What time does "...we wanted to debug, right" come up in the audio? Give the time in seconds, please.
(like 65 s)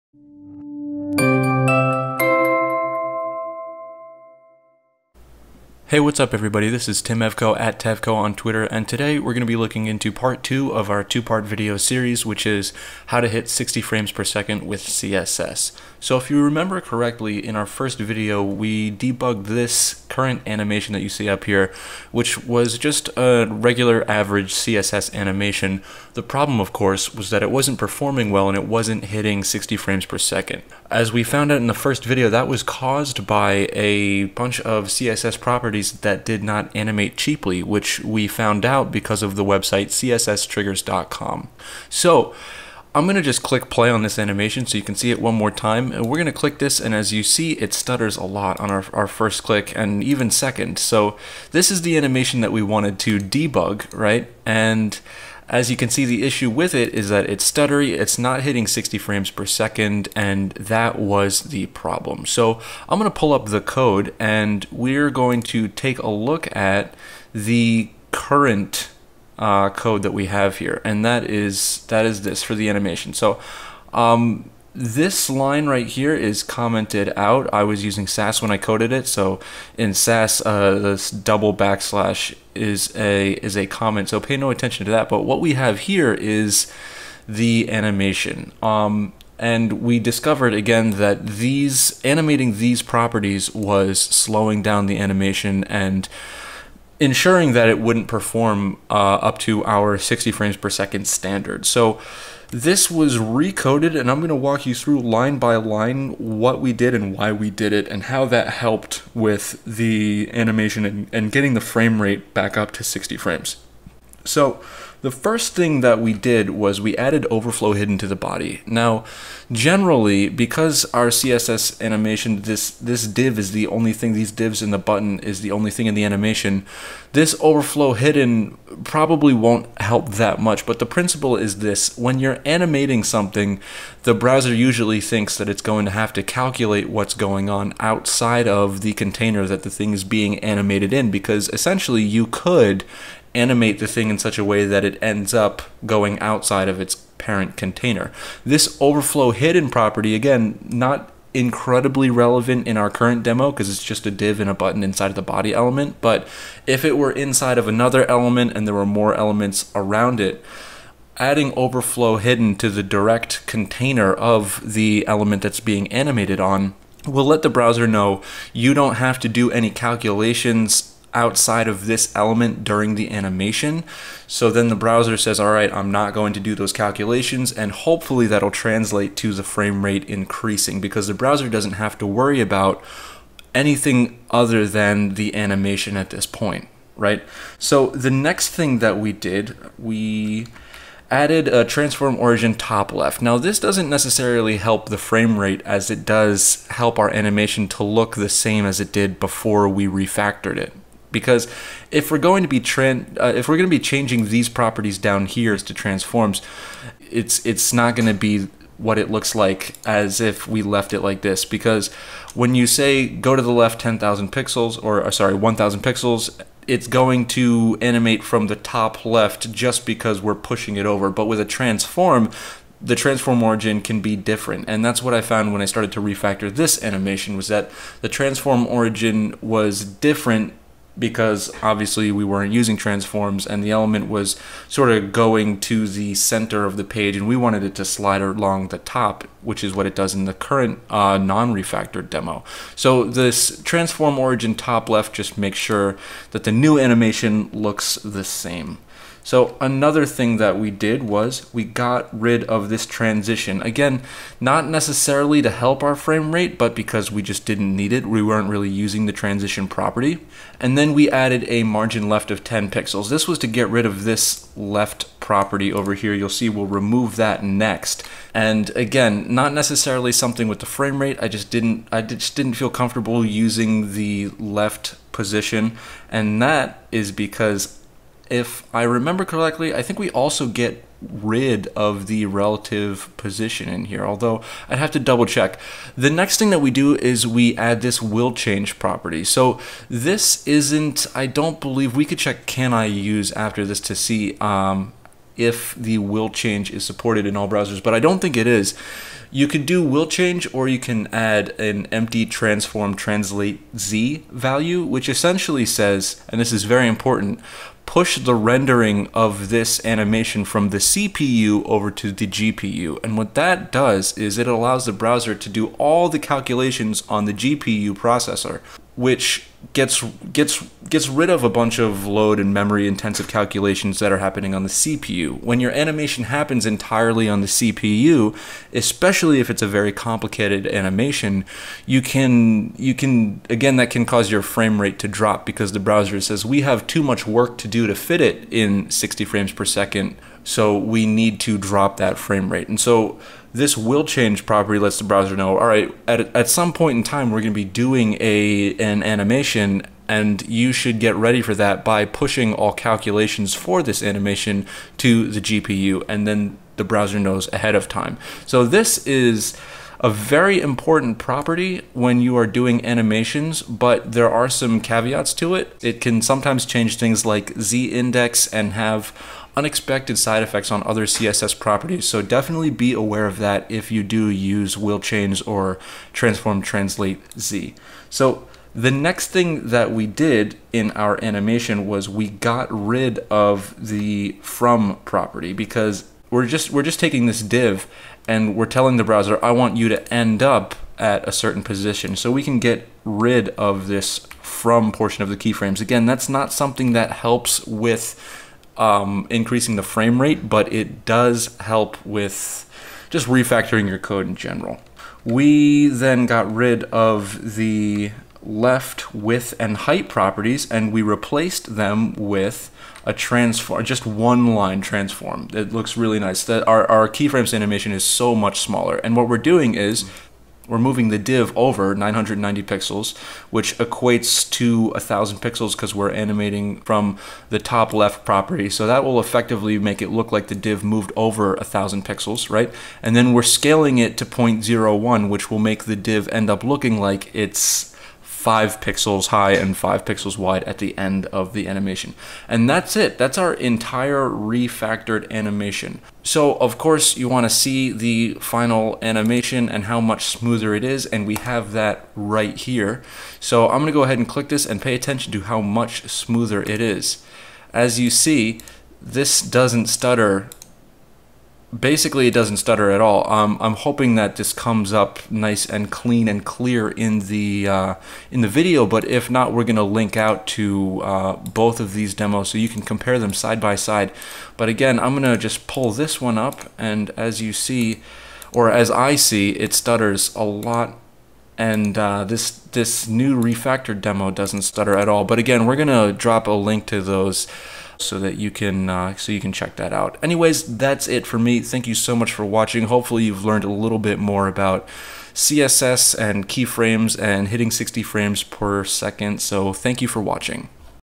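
52 s.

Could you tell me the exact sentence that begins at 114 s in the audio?
So the first thing that we did was we added overflow hidden to the body.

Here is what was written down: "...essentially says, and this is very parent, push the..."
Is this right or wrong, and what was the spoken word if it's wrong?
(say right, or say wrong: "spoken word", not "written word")
wrong: "important", not "parent".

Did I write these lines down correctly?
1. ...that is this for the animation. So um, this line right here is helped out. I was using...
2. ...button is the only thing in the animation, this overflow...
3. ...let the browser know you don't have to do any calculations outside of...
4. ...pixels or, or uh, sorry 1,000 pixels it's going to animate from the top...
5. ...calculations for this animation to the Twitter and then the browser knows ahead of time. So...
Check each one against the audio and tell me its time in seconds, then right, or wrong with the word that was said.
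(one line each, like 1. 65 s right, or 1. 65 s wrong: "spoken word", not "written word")
1. 71 s wrong: "commented", not "helped"
2. 124 s right
3. 167 s right
4. 214 s right
5. 352 s wrong: "GPU", not "Twitter".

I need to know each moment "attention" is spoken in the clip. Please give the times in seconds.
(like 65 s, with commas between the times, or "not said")
84 s, 454 s.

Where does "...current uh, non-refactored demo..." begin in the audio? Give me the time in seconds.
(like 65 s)
240 s.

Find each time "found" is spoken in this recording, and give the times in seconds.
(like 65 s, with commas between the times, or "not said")
31 s, 38 s, 225 s.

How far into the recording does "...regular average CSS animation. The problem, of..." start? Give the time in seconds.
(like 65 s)
23 s.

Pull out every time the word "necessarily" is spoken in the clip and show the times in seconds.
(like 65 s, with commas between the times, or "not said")
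193 s, 254 s, 269 s.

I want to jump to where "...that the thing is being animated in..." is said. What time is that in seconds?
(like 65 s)
139 s.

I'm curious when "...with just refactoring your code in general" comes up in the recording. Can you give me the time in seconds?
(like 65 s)
402 s.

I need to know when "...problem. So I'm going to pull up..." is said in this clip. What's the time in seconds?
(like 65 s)
61 s.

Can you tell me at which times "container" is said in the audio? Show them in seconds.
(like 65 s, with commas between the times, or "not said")
138 s, 147 s, 163 s.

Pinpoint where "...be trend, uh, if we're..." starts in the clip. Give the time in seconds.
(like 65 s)
202 s.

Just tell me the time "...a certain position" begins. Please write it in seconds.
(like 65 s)
391 s.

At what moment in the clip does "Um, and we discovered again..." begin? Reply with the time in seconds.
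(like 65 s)
88 s.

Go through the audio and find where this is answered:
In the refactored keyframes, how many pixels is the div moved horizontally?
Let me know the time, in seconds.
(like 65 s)
421 s.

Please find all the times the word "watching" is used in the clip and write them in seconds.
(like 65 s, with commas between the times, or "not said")
492 s, 500 s.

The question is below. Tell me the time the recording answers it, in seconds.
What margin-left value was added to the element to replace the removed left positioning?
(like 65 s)
261 s.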